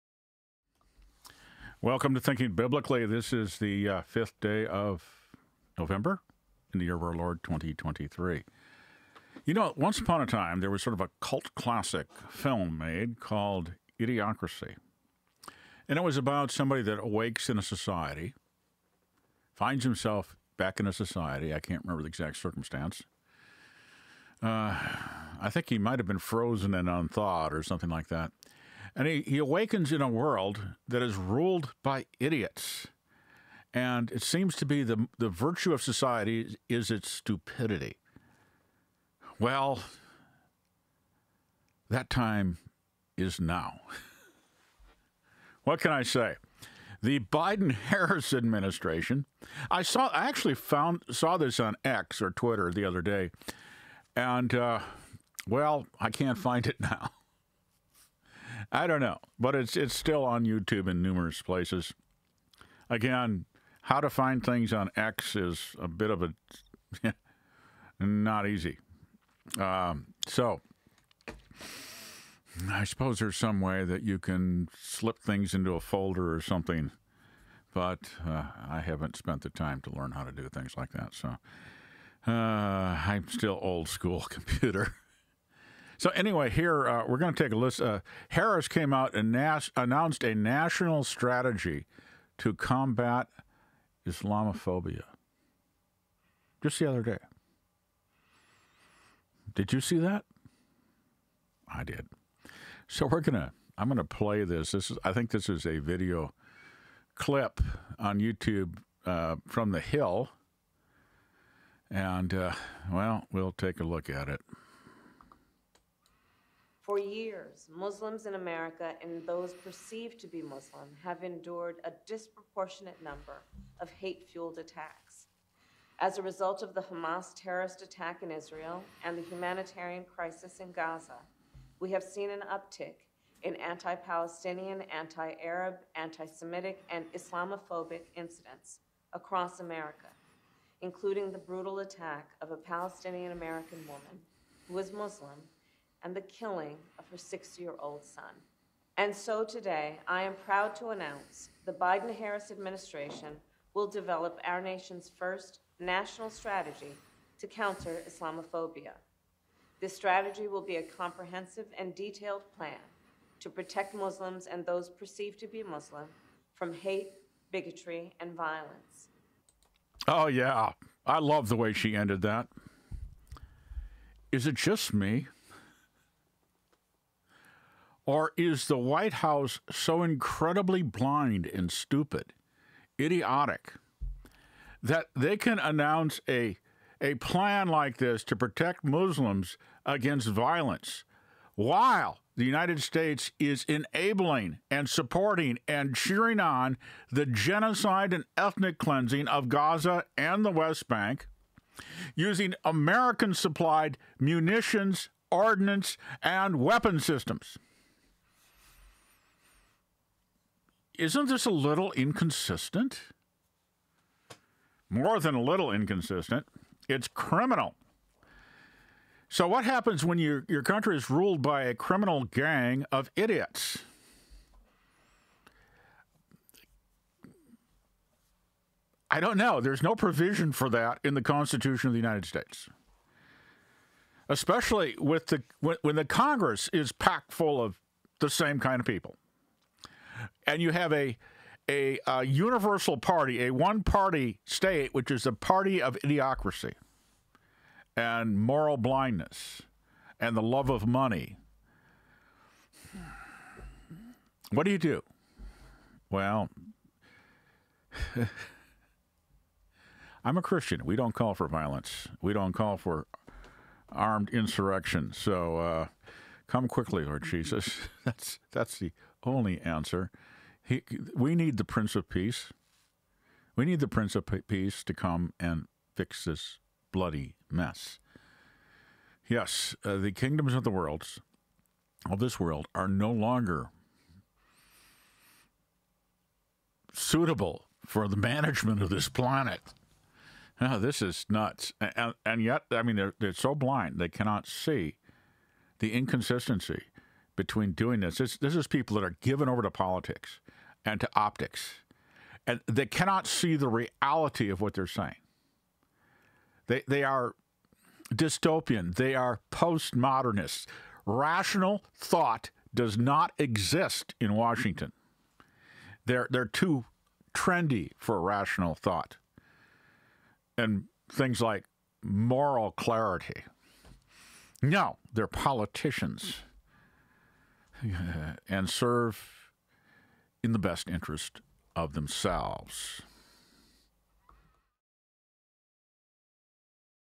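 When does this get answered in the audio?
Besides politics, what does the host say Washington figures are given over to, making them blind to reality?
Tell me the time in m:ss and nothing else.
5:01.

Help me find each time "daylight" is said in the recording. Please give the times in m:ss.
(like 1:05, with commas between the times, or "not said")
not said.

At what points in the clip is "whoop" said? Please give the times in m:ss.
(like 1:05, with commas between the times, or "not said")
not said.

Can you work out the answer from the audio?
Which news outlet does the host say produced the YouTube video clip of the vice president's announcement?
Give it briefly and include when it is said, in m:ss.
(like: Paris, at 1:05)
The Hill, at 1:49.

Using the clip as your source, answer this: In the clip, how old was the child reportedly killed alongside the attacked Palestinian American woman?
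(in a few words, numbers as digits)
6.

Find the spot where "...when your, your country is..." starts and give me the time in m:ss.
3:40.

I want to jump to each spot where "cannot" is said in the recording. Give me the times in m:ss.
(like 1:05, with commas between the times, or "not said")
4:54, 5:02.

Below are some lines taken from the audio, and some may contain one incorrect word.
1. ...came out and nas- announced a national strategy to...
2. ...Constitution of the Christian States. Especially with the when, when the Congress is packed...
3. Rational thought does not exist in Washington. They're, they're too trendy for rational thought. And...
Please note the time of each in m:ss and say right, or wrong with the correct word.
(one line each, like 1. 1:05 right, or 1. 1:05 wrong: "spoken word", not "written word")
1. 1:28 right
2. 3:51 wrong: "United", not "Christian"
3. 5:11 right.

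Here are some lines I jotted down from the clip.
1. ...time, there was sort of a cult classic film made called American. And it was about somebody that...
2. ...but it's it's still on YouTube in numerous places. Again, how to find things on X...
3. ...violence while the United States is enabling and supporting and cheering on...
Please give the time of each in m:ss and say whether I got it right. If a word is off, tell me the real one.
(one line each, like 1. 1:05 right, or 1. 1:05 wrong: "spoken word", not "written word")
1. 0:10 wrong: "Idiocracy", not "American"
2. 0:59 right
3. 3:10 right.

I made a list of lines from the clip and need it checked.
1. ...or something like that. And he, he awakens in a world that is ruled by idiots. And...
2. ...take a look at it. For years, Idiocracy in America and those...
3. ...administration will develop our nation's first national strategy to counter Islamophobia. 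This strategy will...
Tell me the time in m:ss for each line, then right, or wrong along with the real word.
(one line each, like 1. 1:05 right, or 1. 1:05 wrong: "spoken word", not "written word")
1. 0:27 right
2. 1:53 wrong: "Muslims", not "Idiocracy"
3. 2:32 right.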